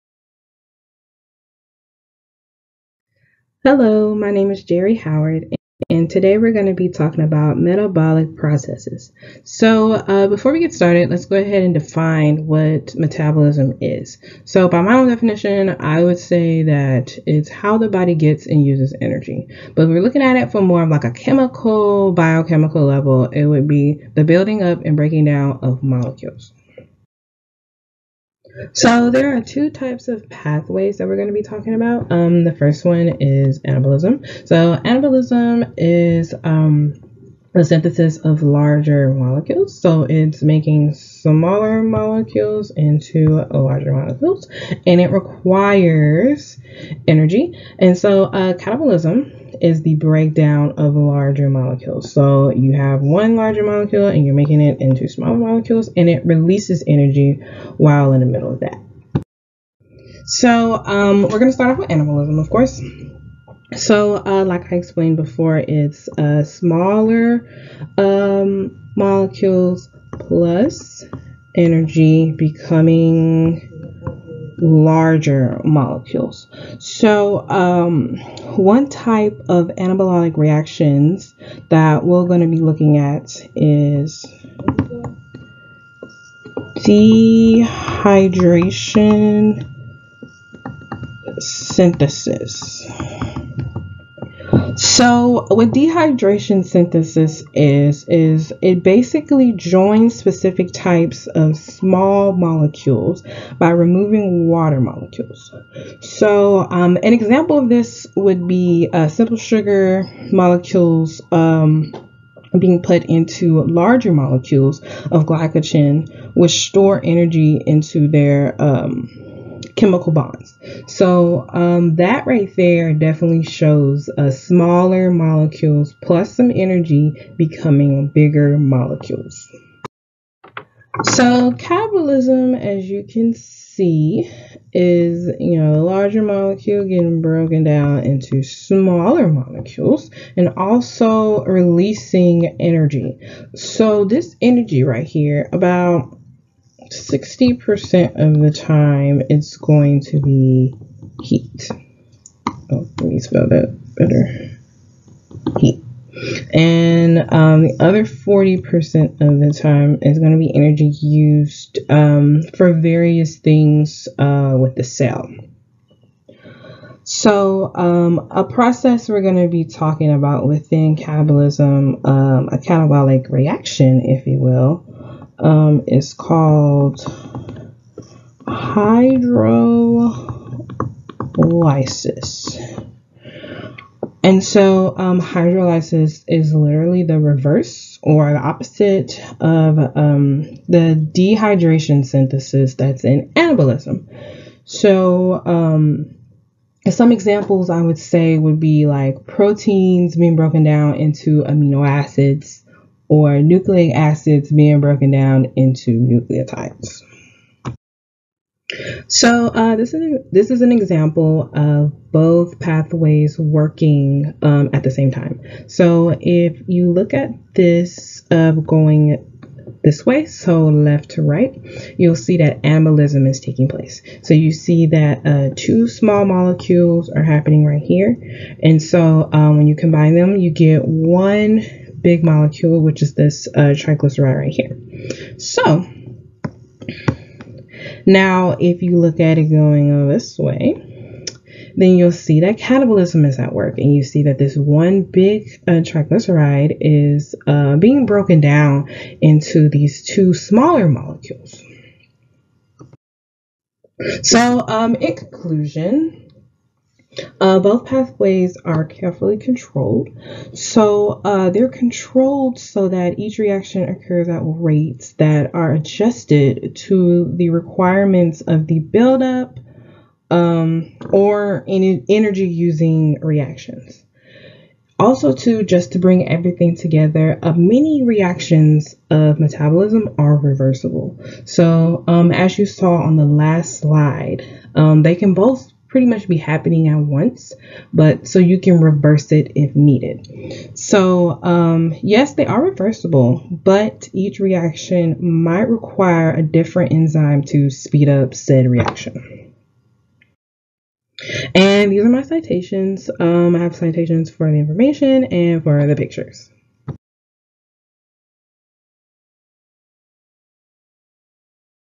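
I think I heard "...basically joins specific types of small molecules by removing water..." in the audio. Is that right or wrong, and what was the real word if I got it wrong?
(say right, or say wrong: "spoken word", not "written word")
right.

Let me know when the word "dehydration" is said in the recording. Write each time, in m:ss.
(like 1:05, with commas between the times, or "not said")
1:26, 1:35, 3:11.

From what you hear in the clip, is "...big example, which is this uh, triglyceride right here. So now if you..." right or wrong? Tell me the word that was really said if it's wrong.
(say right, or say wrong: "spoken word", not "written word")
wrong: "molecule", not "example".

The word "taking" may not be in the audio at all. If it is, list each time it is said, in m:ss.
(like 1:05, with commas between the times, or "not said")
3:43.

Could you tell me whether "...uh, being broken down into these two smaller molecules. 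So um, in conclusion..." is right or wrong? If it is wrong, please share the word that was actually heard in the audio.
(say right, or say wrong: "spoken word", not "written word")
right.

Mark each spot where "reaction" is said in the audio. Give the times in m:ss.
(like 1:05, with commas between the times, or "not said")
1:20, 2:53, 4:23, 4:33, 4:38, 4:54, 4:58.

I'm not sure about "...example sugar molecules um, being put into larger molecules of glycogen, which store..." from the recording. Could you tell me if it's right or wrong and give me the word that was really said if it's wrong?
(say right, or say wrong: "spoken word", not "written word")
wrong: "simple", not "example".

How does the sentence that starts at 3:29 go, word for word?
So uh, this is this is an example of both pathways working um, at the same time.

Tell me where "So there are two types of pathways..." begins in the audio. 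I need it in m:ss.
0:28.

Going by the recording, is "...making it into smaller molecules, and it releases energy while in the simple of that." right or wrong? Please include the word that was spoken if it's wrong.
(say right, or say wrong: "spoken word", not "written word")
wrong: "middle", not "simple".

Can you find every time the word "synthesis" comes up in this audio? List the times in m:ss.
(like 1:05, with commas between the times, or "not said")
0:37, 1:31, 1:36, 3:12.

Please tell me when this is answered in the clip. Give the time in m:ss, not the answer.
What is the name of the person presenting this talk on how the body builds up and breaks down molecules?
0:04.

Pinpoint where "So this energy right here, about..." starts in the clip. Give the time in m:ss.
2:23.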